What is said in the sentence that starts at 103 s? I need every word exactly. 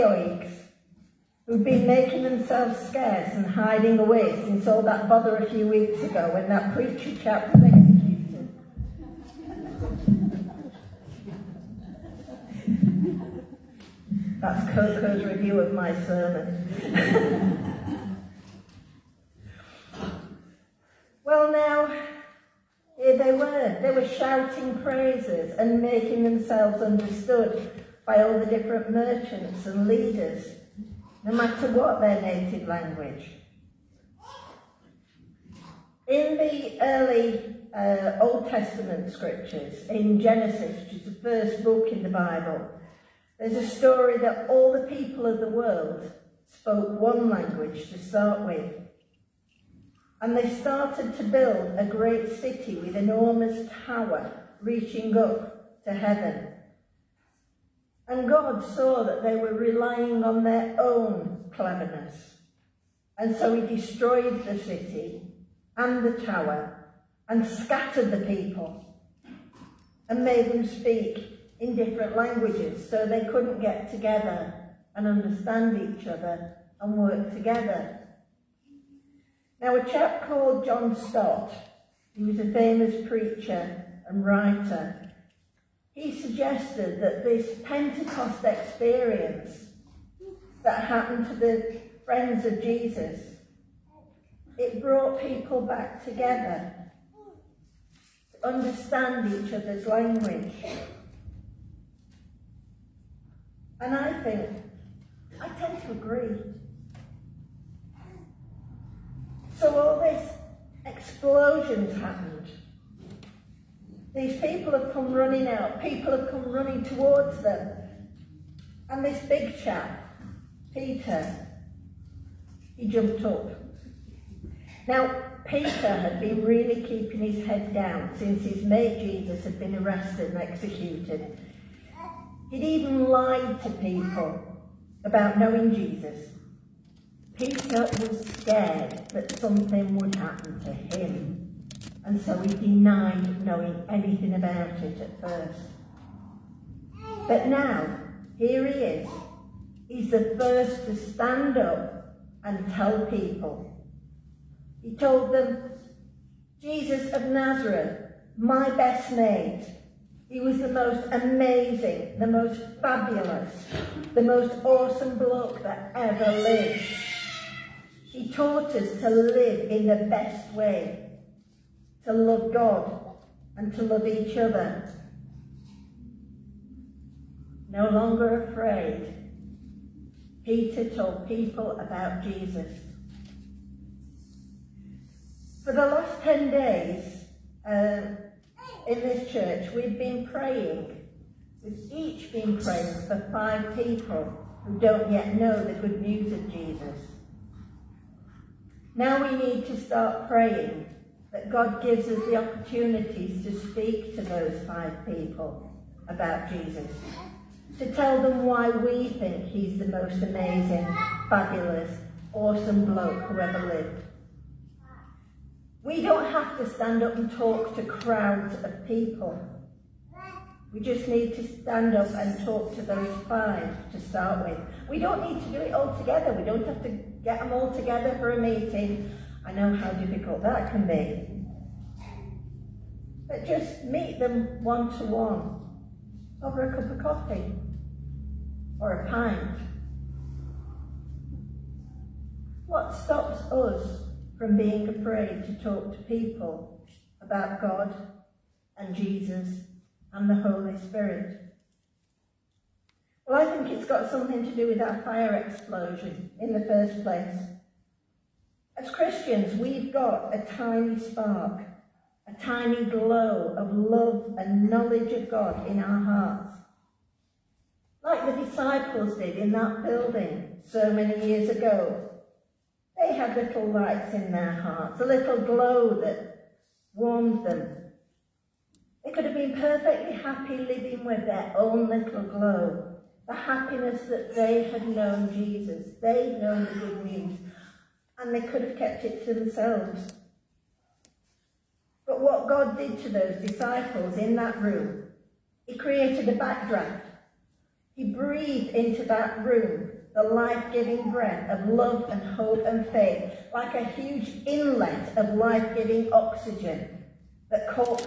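And I think, I tend to agree.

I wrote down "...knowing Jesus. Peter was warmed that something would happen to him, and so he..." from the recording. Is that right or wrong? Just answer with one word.
wrong.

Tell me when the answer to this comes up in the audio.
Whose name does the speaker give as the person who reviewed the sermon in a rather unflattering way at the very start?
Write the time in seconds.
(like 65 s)
14 s.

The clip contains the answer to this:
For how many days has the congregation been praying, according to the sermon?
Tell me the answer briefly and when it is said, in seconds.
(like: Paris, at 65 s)
10, at 186 s.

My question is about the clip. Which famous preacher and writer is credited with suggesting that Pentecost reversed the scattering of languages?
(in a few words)
John Stott.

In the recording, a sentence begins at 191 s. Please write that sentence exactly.
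We've each been praying for five people who don't yet know the good news of Jesus.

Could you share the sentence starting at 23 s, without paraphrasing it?
They were shouting praises and making themselves understood by all the different merchants and leaders, no matter what their native language.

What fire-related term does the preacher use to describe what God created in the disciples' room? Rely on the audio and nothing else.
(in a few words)
backdraft.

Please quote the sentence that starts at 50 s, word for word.
And they started to build a great city with enormous tower reaching up to heaven.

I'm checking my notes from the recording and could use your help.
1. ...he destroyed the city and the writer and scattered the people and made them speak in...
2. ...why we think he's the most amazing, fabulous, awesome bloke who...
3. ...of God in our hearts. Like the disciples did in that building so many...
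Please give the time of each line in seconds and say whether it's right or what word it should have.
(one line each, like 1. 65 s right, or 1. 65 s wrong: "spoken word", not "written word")
1. 63 s wrong: "tower", not "writer"
2. 208 s right
3. 265 s right.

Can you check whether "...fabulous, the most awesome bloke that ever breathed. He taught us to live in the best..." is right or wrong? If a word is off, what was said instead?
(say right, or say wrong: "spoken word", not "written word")
wrong: "lived", not "breathed".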